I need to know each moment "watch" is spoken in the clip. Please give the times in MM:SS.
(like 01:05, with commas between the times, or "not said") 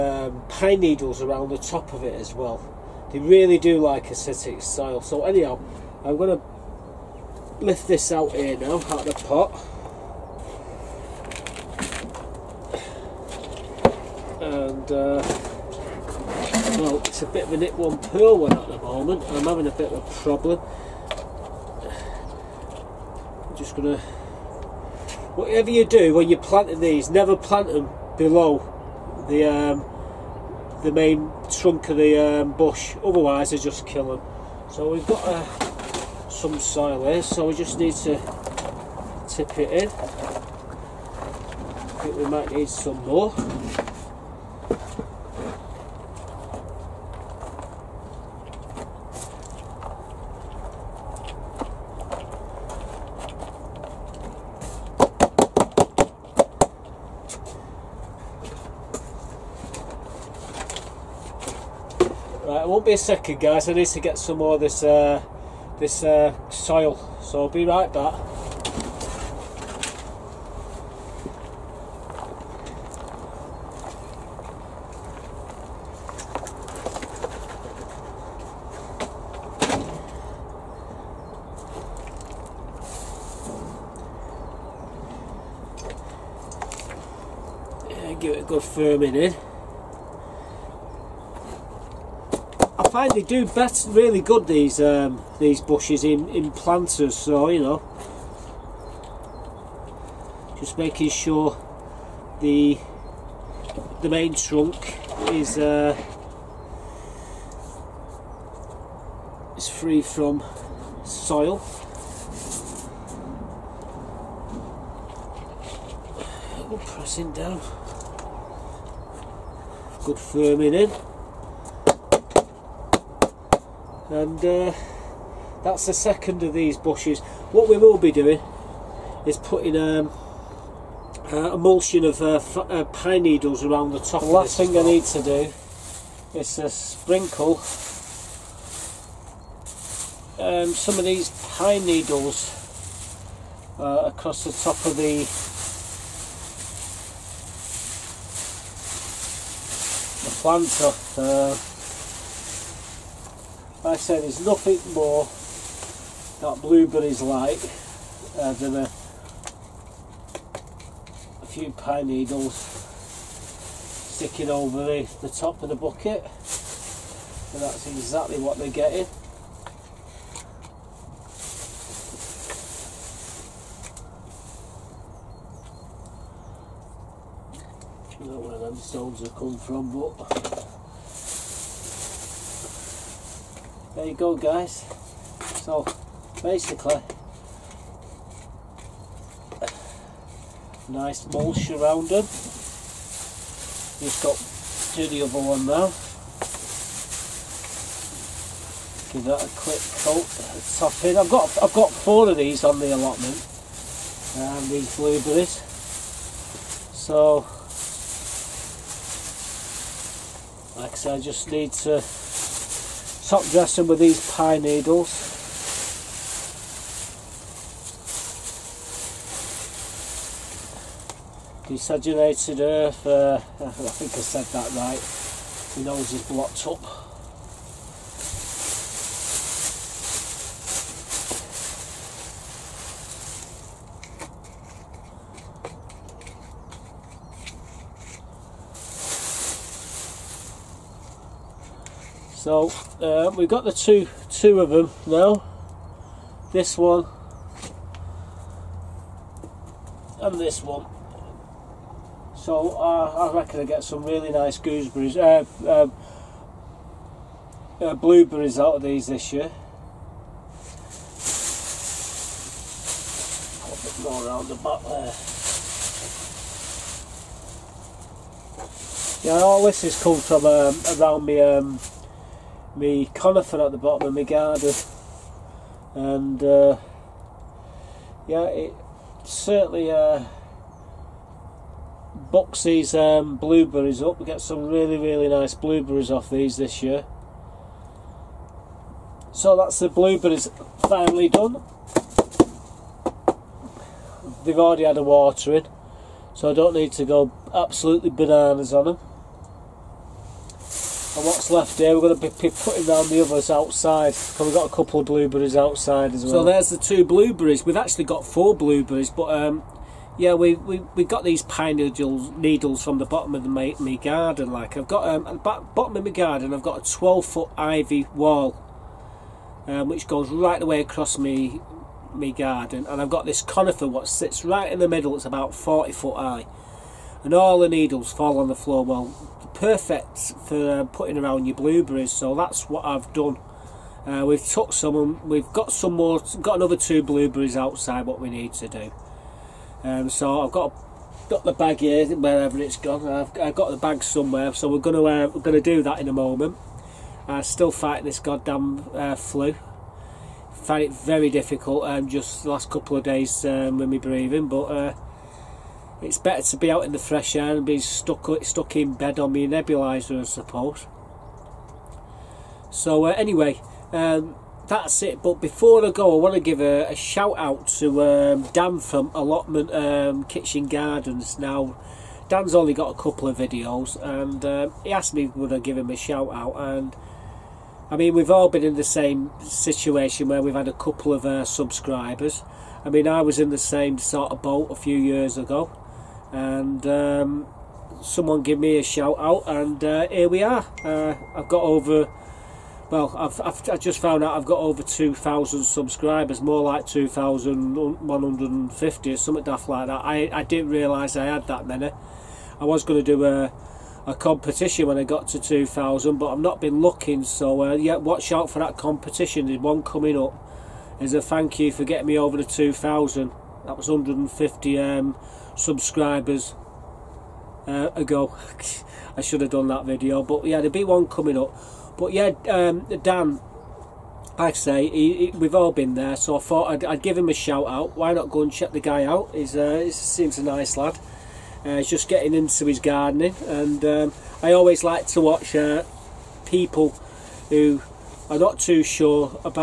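06:47, 07:15.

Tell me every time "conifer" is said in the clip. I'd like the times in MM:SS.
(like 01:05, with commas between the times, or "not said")
04:33, 05:23.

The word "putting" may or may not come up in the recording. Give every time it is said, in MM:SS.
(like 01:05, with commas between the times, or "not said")
02:09, 05:02, 05:30.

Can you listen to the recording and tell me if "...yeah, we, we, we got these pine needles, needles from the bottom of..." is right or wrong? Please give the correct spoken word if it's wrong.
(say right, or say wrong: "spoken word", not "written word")
right.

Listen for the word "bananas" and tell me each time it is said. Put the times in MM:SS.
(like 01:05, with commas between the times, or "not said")
04:58.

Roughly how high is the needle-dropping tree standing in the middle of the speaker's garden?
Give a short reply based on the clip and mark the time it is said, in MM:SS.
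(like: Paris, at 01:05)
40 foot, at 05:25.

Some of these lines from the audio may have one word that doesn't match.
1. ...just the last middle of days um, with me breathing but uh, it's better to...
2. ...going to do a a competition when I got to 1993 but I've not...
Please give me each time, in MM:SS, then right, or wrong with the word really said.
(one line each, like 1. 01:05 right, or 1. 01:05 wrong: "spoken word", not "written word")
1. 05:52 wrong: "couple", not "middle"
2. 06:42 wrong: "2000", not "1993".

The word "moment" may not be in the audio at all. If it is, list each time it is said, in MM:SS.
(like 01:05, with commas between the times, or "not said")
00:18, 05:46.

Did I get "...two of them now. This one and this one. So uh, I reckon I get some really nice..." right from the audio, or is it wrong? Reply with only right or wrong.
right.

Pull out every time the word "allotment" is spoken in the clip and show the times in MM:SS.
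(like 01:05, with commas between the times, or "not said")
03:22, 06:09.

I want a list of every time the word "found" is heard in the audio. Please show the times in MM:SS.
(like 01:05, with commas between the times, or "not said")
06:33.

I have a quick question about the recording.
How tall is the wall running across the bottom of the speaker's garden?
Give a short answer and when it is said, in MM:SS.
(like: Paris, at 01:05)
12 foot, at 05:16.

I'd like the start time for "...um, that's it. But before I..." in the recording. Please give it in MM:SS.
06:03.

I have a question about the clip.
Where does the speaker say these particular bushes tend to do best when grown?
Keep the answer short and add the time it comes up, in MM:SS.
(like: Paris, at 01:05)
In planters, at 01:36.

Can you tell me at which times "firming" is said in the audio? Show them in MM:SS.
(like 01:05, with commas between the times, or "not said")
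01:28, 02:00.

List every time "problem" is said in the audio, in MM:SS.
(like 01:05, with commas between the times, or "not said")
00:20.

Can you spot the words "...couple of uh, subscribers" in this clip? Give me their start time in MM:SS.
06:20.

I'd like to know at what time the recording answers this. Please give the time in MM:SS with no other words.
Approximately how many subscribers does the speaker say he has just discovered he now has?
06:36.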